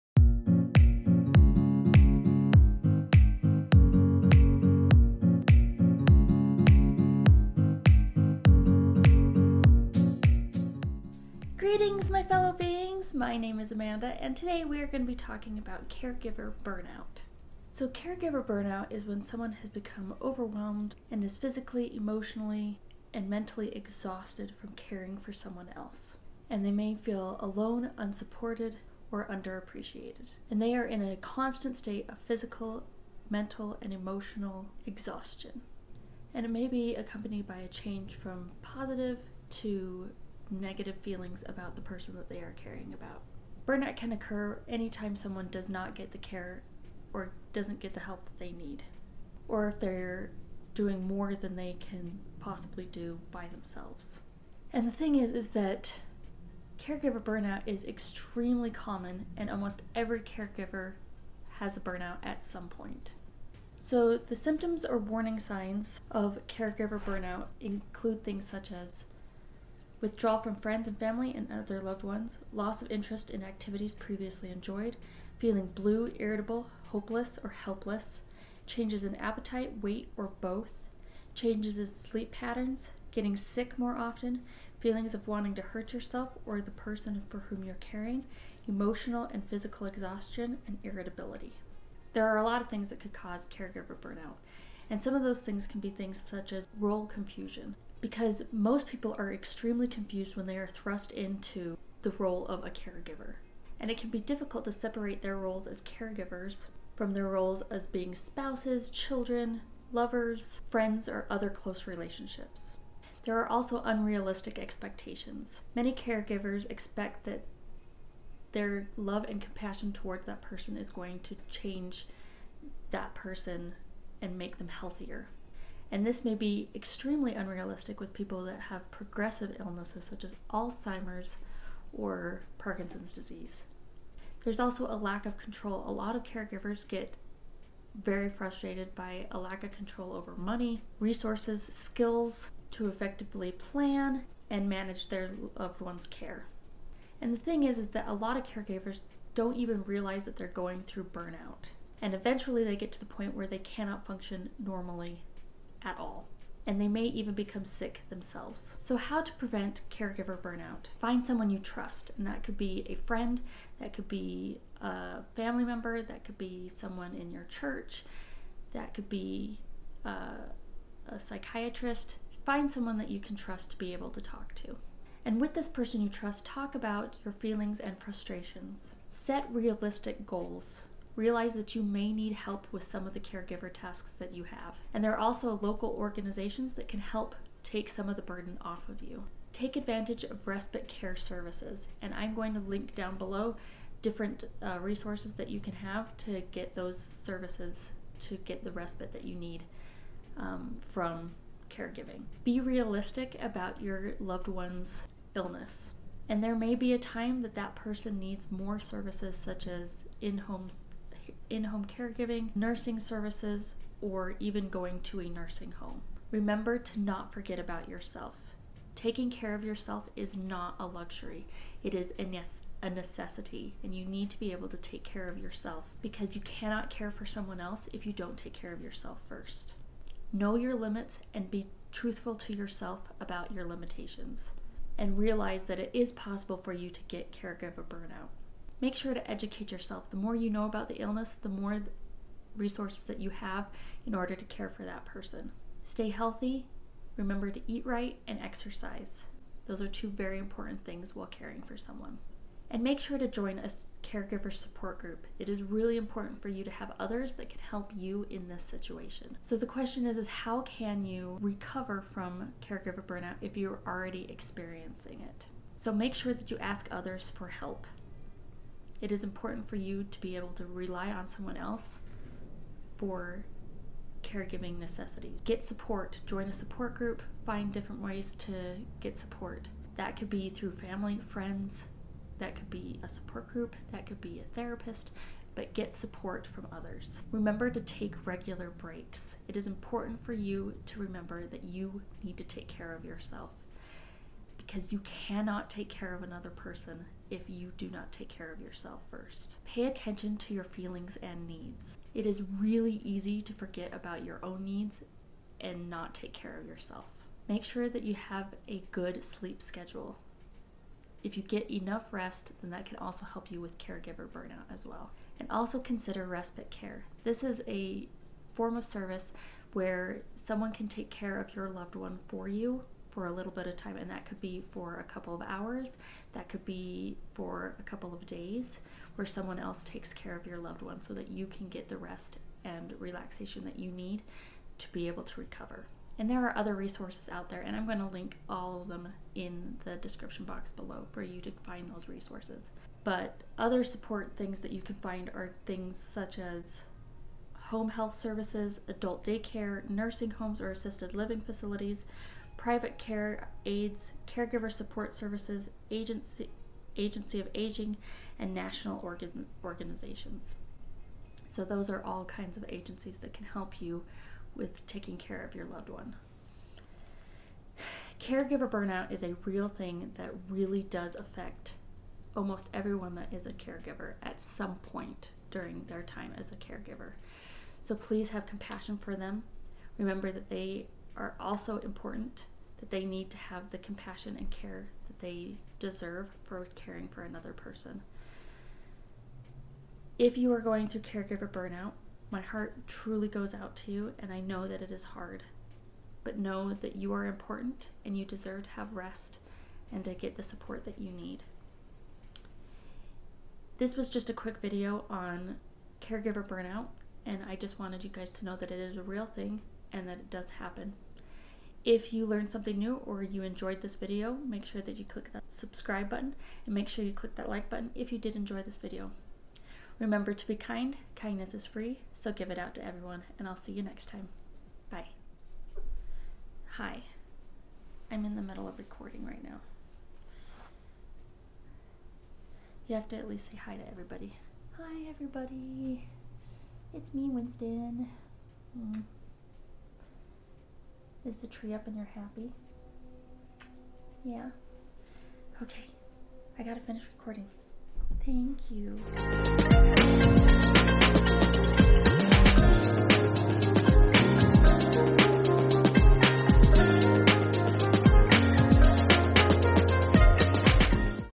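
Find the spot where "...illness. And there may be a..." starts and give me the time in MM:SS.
03:25.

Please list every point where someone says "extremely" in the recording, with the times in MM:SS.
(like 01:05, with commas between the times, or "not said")
00:57, 01:39, 02:06.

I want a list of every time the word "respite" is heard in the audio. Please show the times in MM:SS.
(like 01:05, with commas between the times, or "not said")
03:10, 03:18, 05:16.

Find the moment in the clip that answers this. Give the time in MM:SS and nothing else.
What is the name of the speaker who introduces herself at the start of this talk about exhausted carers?
00:13.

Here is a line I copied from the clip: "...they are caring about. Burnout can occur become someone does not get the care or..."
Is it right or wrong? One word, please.
wrong.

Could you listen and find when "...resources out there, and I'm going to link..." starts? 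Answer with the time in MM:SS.
05:36.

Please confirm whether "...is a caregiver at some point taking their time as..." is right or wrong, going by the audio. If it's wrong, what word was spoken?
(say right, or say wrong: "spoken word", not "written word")
wrong: "during", not "taking".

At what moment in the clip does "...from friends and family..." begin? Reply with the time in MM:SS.
01:10.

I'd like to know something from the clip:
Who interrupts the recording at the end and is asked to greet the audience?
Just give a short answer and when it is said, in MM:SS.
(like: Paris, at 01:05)
Winston, at 07:17.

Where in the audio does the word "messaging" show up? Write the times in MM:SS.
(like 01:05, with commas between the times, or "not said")
not said.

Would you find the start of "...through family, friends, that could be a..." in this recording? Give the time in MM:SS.
04:40.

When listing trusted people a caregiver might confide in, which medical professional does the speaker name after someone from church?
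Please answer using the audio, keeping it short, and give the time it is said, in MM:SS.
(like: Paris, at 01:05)
A psychiatrist, at 02:51.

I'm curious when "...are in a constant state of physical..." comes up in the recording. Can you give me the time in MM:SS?
00:30.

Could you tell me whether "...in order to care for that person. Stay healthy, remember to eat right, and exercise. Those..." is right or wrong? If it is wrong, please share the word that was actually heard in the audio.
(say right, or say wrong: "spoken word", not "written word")
right.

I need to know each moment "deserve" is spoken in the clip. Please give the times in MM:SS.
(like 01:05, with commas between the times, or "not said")
06:25, 06:38.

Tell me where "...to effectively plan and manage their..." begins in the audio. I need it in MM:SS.
02:22.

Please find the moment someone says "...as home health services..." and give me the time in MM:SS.
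05:46.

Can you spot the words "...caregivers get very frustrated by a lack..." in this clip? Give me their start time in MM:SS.
02:16.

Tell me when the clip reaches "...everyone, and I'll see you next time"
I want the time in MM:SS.
07:02.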